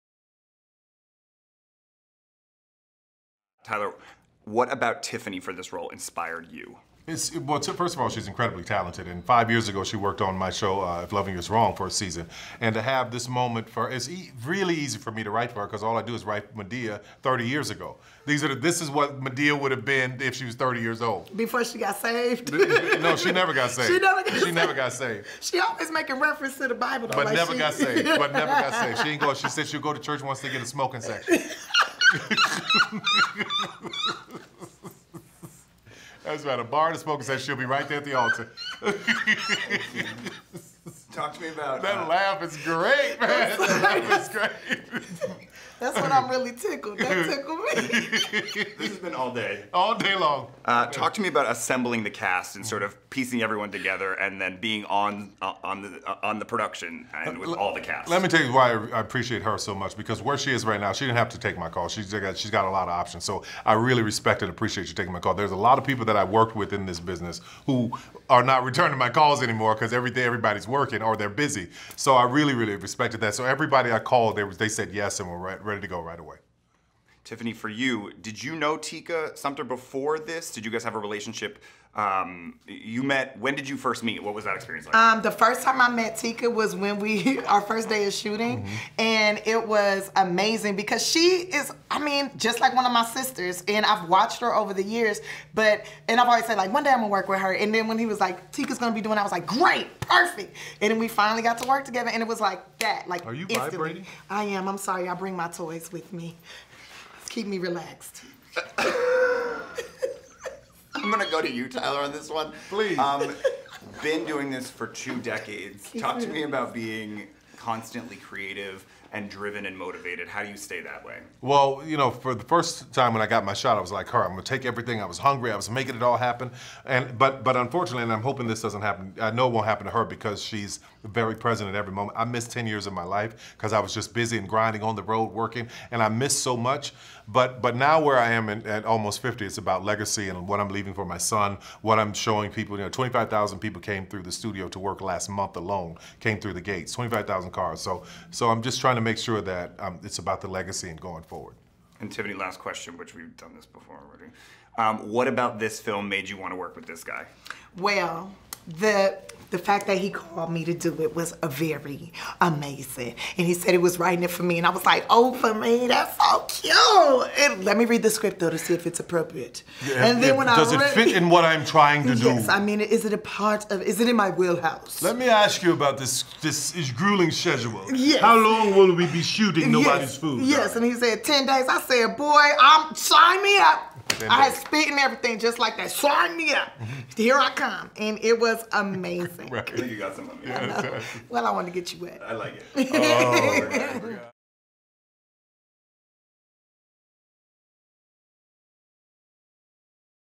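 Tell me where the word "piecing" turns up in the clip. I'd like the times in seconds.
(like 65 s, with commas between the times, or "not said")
53 s.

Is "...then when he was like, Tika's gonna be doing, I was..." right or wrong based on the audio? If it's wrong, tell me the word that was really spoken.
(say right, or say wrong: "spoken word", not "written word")
right.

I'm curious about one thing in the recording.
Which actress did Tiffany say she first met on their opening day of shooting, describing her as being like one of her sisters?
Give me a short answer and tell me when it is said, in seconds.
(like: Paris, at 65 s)
Tika Sumter, at 78 s.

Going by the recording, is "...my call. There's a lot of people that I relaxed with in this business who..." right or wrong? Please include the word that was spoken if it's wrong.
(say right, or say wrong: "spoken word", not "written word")
wrong: "worked", not "relaxed".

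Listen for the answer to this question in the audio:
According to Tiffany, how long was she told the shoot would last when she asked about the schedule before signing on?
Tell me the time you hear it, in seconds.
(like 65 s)
181 s.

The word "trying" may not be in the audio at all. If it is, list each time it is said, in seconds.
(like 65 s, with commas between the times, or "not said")
148 s, 171 s.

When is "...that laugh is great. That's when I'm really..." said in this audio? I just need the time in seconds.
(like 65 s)
43 s.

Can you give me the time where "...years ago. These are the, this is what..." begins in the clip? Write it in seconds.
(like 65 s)
17 s.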